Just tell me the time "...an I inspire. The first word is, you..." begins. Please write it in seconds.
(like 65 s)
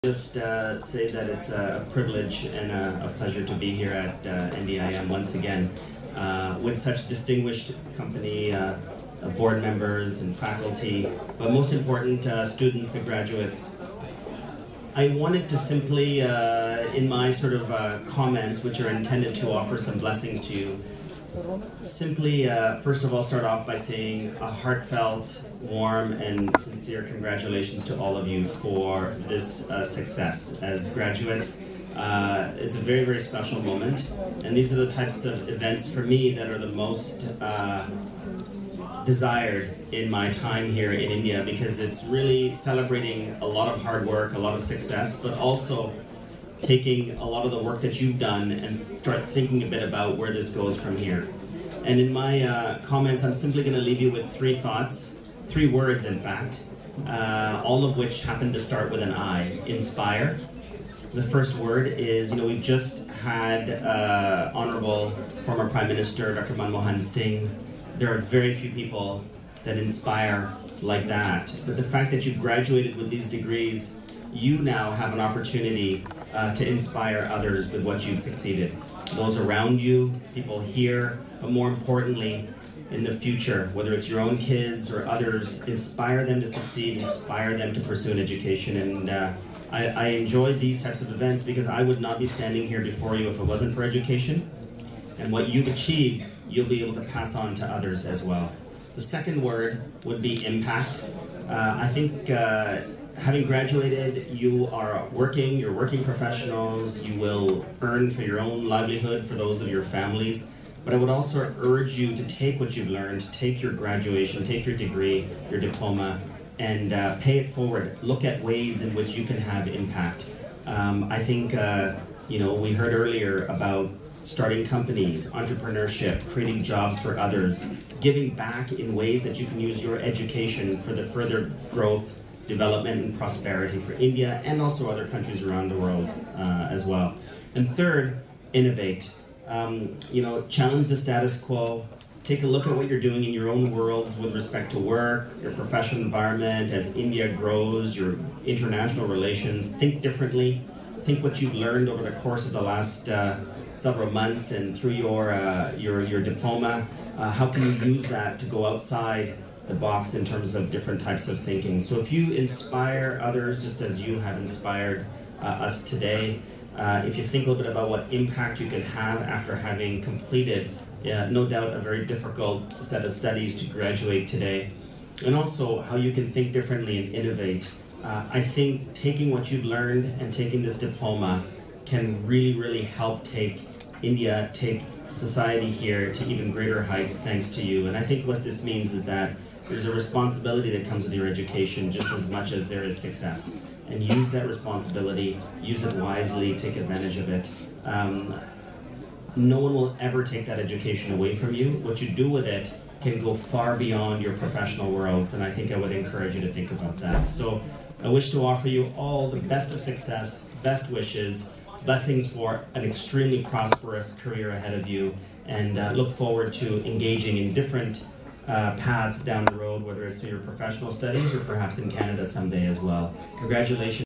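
59 s.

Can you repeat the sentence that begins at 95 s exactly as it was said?
And what you've achieved, you'll be able to pass on to others as well.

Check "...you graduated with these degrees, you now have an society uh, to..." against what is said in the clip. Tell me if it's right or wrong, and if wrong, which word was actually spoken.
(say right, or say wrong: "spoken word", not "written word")
wrong: "opportunity", not "society".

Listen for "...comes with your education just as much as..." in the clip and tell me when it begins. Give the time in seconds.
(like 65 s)
190 s.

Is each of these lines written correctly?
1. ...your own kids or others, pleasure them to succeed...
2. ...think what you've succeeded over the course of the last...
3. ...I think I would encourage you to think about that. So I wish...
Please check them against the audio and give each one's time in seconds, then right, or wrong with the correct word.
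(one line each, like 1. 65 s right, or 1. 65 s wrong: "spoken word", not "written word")
1. 84 s wrong: "inspire", not "pleasure"
2. 151 s wrong: "learned", not "succeeded"
3. 205 s right.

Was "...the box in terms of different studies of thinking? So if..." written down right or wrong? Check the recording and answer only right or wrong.
wrong.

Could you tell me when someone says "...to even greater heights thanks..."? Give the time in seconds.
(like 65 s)
186 s.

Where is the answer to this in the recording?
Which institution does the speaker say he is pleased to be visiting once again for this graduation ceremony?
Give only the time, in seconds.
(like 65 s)
4 s.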